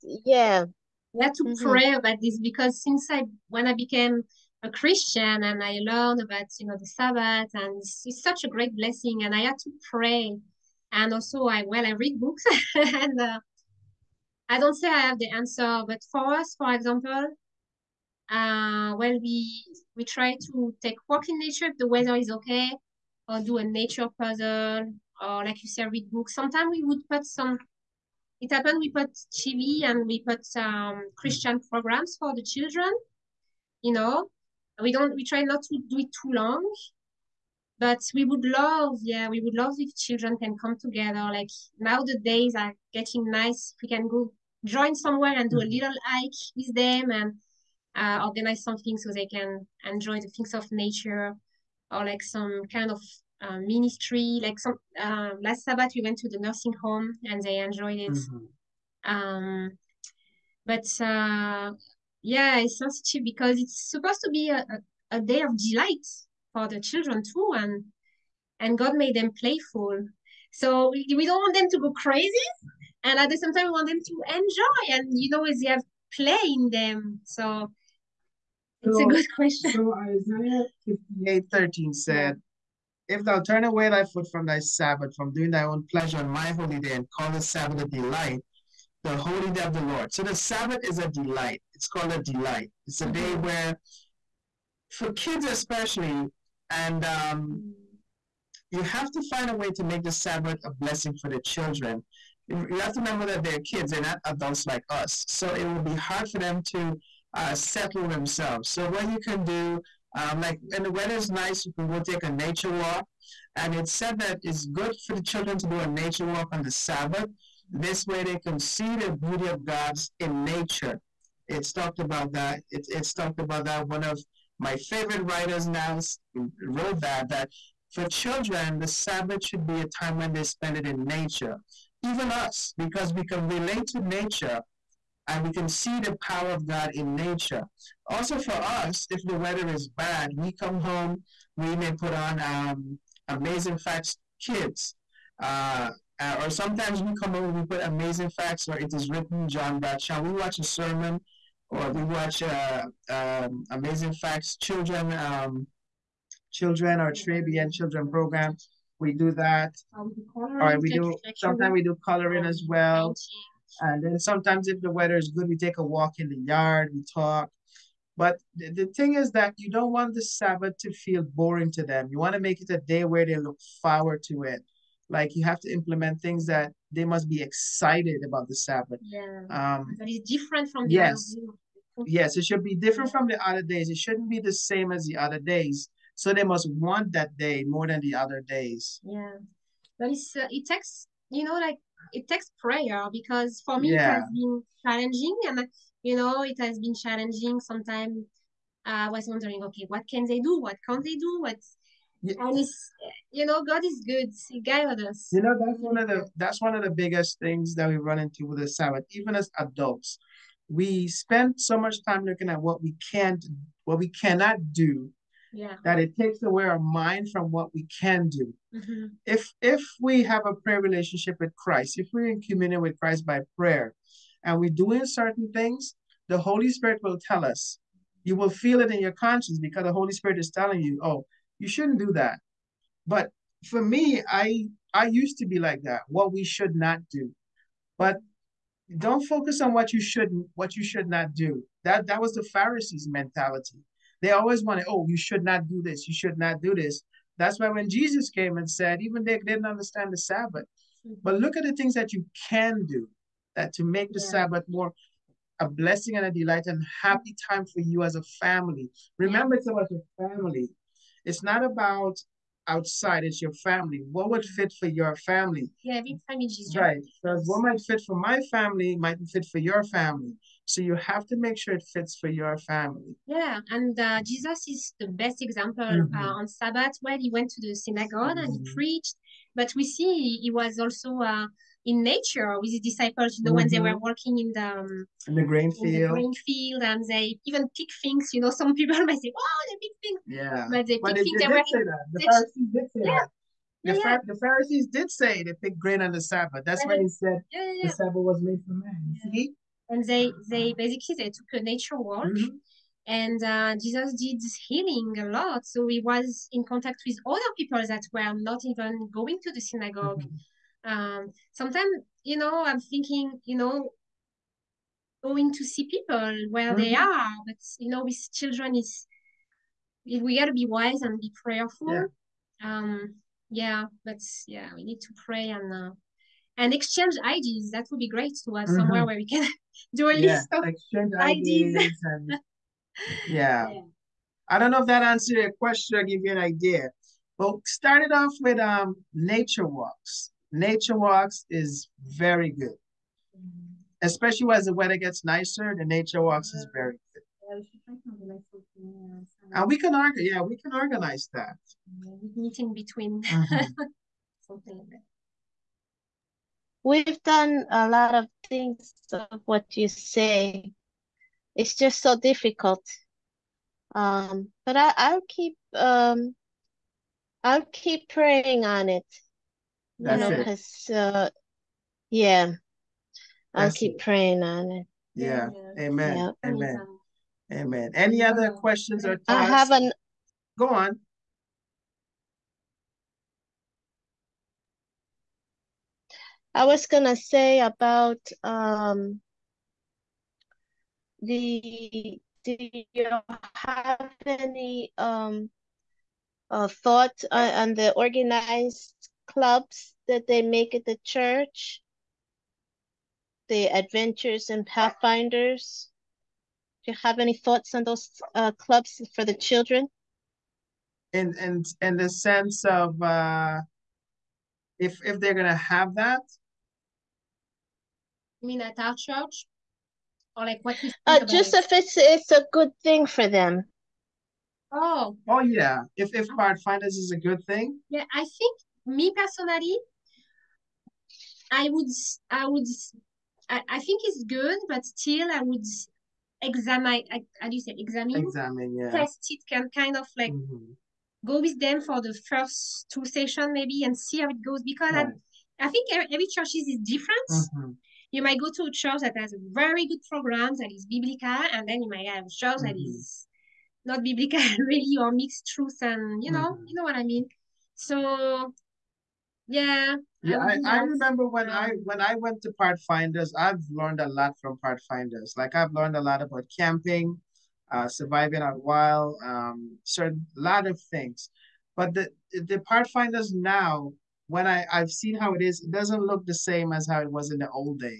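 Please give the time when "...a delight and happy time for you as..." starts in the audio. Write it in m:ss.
4:16.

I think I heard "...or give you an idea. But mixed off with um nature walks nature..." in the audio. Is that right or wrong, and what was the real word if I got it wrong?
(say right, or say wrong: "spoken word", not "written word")
wrong: "started", not "mixed".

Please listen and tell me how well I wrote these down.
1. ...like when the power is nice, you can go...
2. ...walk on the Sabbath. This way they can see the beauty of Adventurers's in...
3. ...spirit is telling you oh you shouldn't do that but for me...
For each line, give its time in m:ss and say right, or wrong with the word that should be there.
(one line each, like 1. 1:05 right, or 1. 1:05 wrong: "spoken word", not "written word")
1. 1:50 wrong: "weather", not "power"
2. 1:56 wrong: "God", not "Adventurers"
3. 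3:50 right.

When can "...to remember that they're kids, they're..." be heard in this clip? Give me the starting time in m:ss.
1:42.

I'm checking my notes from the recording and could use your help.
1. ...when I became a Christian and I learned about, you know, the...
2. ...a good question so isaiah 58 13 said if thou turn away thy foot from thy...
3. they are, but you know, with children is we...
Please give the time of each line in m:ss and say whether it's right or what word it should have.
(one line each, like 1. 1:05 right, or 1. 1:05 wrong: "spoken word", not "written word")
1. 0:03 right
2. 1:19 right
3. 5:16 right.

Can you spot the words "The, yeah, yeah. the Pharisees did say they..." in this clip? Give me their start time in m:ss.
4:53.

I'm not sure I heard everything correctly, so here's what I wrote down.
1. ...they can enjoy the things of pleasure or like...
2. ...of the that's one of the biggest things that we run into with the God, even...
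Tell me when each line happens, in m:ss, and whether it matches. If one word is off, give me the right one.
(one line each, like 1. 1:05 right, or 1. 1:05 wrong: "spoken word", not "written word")
1. 0:49 wrong: "nature", not "pleasure"
2. 3:25 wrong: "Sabbath", not "God".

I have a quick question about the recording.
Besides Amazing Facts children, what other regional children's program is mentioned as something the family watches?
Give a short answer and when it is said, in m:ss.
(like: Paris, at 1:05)
Caribbean children program, at 2:37.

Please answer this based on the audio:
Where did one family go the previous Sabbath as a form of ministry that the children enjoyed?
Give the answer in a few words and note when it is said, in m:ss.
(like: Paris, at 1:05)
the nursing home, at 0:56.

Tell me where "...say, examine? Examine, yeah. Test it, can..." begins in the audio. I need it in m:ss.
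7:17.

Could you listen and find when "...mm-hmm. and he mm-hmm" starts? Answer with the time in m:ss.
4:38.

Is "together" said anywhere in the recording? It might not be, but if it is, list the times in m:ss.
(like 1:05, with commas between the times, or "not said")
0:40.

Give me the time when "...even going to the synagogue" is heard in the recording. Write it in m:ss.
5:08.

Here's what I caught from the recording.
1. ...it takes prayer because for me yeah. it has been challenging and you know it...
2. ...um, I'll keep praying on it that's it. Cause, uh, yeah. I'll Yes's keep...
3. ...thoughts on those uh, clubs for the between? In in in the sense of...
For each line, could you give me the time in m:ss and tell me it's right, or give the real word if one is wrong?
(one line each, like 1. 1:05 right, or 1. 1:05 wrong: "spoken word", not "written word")
1. 3:12 right
2. 6:05 wrong: "That", not "Yes"
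3. 6:47 wrong: "children", not "between".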